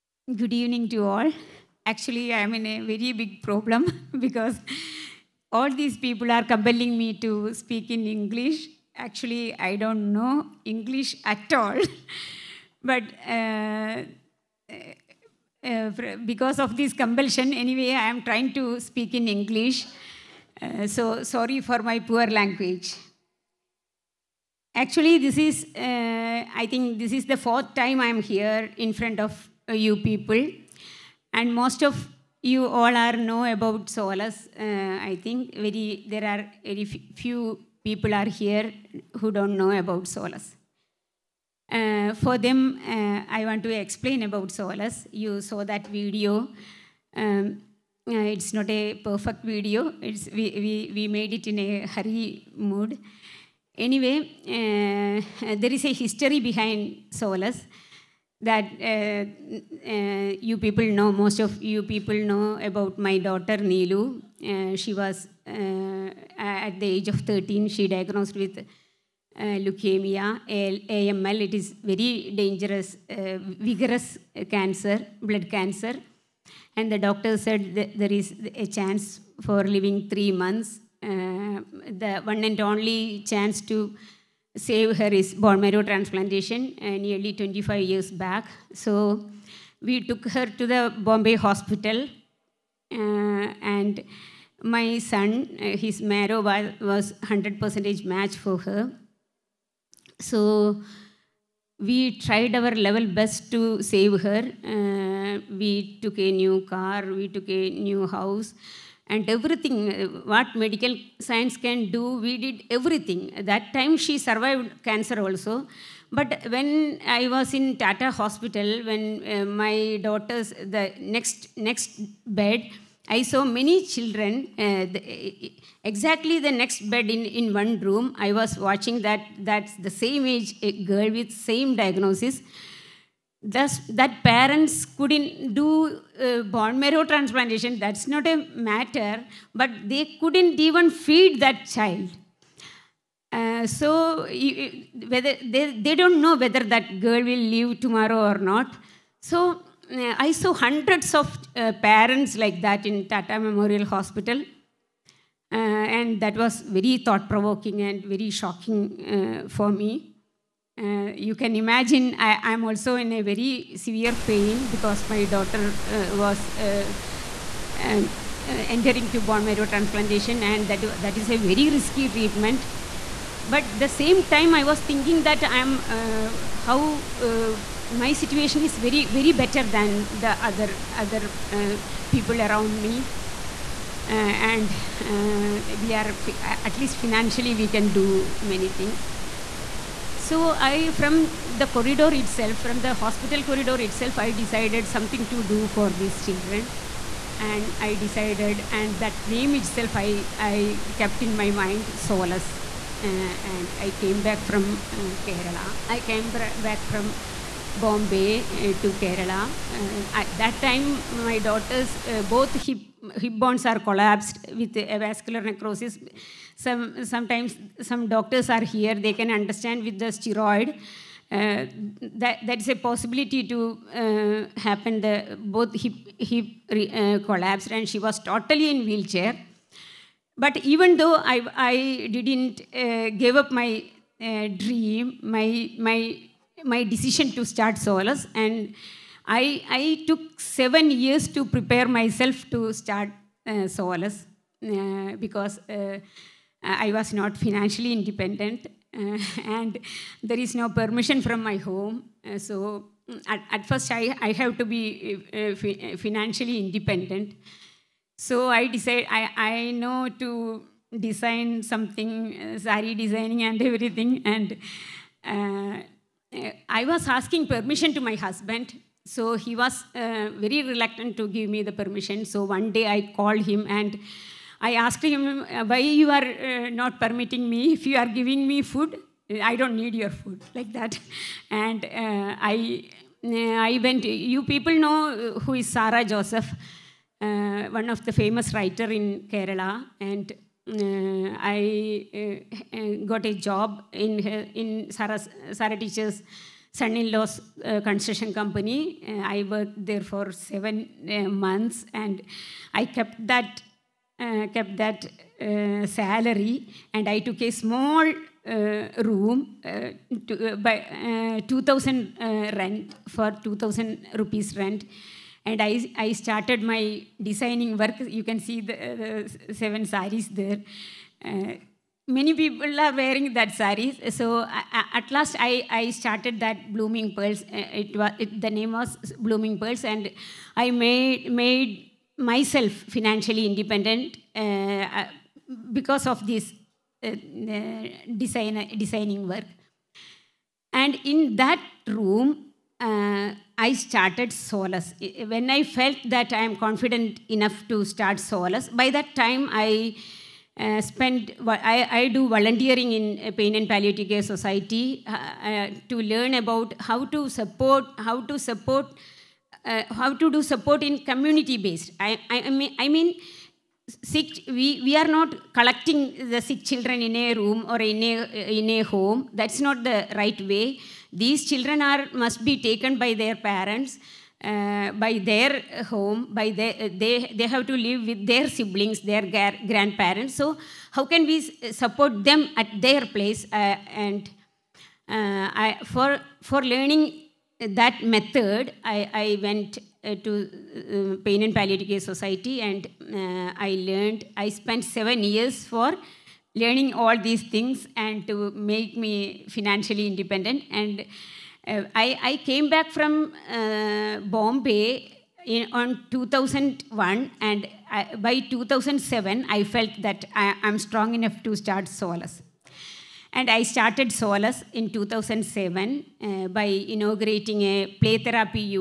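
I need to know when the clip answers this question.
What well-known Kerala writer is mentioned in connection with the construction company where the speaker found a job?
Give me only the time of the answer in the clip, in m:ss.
4:45.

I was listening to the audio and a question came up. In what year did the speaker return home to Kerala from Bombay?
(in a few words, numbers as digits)
2001.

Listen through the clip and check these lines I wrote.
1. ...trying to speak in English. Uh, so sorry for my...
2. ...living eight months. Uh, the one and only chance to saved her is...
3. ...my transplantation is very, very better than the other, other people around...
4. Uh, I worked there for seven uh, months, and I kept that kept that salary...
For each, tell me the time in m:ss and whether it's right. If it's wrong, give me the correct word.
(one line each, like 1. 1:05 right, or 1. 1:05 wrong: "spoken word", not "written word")
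1. 0:18 right
2. 1:19 wrong: "three", not "eight"
3. 2:57 wrong: "situation", not "transplantation"
4. 4:59 right.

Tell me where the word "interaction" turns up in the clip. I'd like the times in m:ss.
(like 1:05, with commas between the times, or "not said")
not said.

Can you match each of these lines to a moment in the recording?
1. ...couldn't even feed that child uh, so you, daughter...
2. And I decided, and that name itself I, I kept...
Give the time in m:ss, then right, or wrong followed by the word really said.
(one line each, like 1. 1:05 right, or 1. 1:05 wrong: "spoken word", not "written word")
1. 2:20 wrong: "whether", not "daughter"
2. 3:17 right.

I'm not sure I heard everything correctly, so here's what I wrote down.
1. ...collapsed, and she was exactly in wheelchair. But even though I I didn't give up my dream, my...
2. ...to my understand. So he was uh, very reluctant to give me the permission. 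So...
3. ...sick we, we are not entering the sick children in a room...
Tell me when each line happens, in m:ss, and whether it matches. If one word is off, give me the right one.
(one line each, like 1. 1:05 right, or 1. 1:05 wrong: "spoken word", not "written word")
1. 3:47 wrong: "totally", not "exactly"
2. 4:27 wrong: "husband", not "understand"
3. 6:04 wrong: "collecting", not "entering".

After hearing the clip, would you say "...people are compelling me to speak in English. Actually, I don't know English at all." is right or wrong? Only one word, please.
right.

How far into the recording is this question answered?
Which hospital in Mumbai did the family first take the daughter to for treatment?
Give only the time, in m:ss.
1:30.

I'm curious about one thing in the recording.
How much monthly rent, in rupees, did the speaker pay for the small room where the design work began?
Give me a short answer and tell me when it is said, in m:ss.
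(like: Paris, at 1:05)
2,000 rupees, at 5:13.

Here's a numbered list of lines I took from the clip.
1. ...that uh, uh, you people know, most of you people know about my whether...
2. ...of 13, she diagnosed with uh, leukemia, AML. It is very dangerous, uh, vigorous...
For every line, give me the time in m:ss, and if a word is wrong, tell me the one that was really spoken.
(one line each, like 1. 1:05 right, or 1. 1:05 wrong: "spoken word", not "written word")
1. 0:58 wrong: "daughter", not "whether"
2. 1:07 right.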